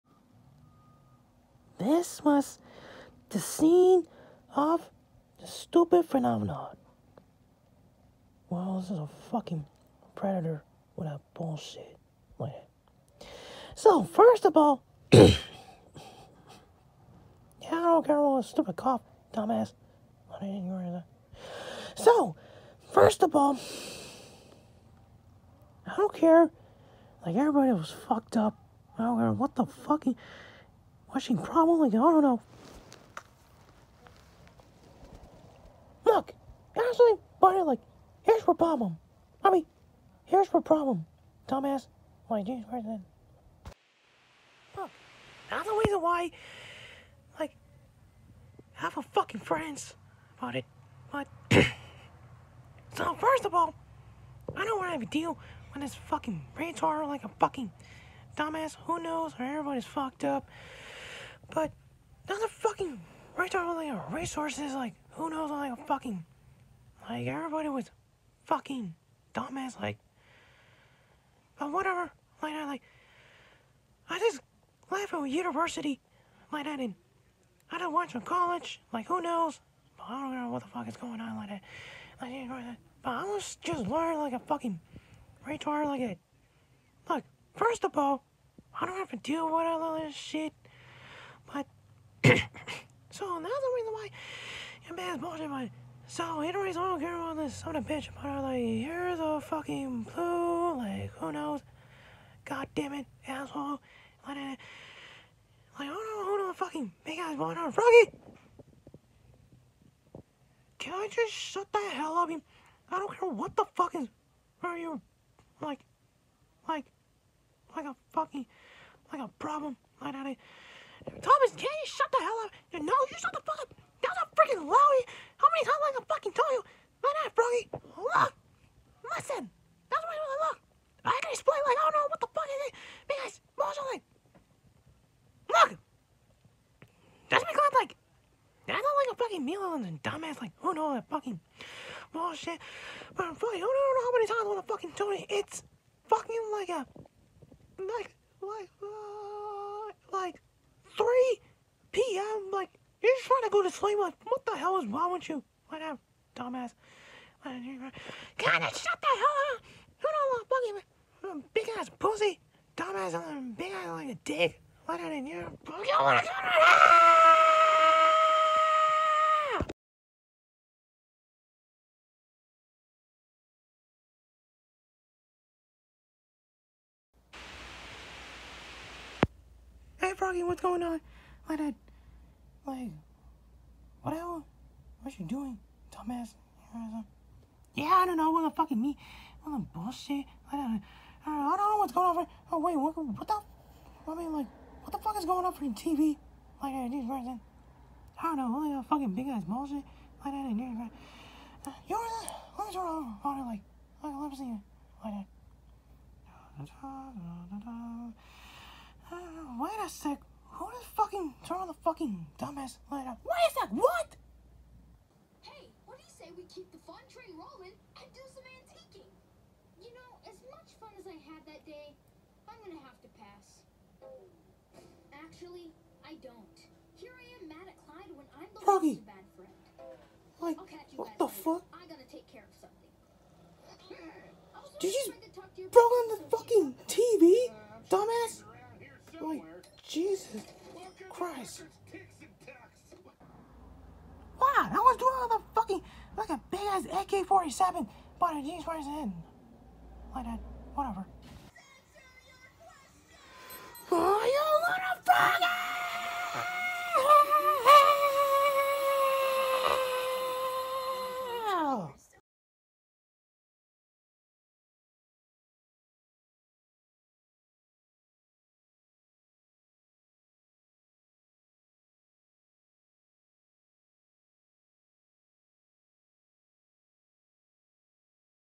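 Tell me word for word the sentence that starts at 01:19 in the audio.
But I don't know what the fuck is going on like that.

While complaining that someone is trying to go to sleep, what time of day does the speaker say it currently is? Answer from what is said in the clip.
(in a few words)
3 p.m.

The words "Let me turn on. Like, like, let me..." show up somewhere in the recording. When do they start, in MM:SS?
03:22.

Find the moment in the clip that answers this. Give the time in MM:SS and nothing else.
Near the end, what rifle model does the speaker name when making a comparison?
04:07.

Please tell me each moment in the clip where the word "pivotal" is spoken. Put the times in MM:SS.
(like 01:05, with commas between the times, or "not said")
not said.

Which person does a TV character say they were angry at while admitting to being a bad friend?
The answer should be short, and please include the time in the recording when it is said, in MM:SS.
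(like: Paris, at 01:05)
Clyde, at 03:47.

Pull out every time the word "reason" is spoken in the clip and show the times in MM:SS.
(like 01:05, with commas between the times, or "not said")
00:45, 01:33.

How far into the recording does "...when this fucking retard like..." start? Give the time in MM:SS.
00:55.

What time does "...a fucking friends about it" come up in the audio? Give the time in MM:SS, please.
00:48.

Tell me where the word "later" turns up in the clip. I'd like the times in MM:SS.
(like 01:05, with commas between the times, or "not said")
03:51.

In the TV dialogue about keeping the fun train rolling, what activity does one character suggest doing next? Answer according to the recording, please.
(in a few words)
Antiquing.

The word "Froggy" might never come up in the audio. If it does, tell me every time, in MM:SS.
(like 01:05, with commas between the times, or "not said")
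01:47, 03:00, 03:48.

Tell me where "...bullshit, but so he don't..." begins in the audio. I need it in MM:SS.
01:35.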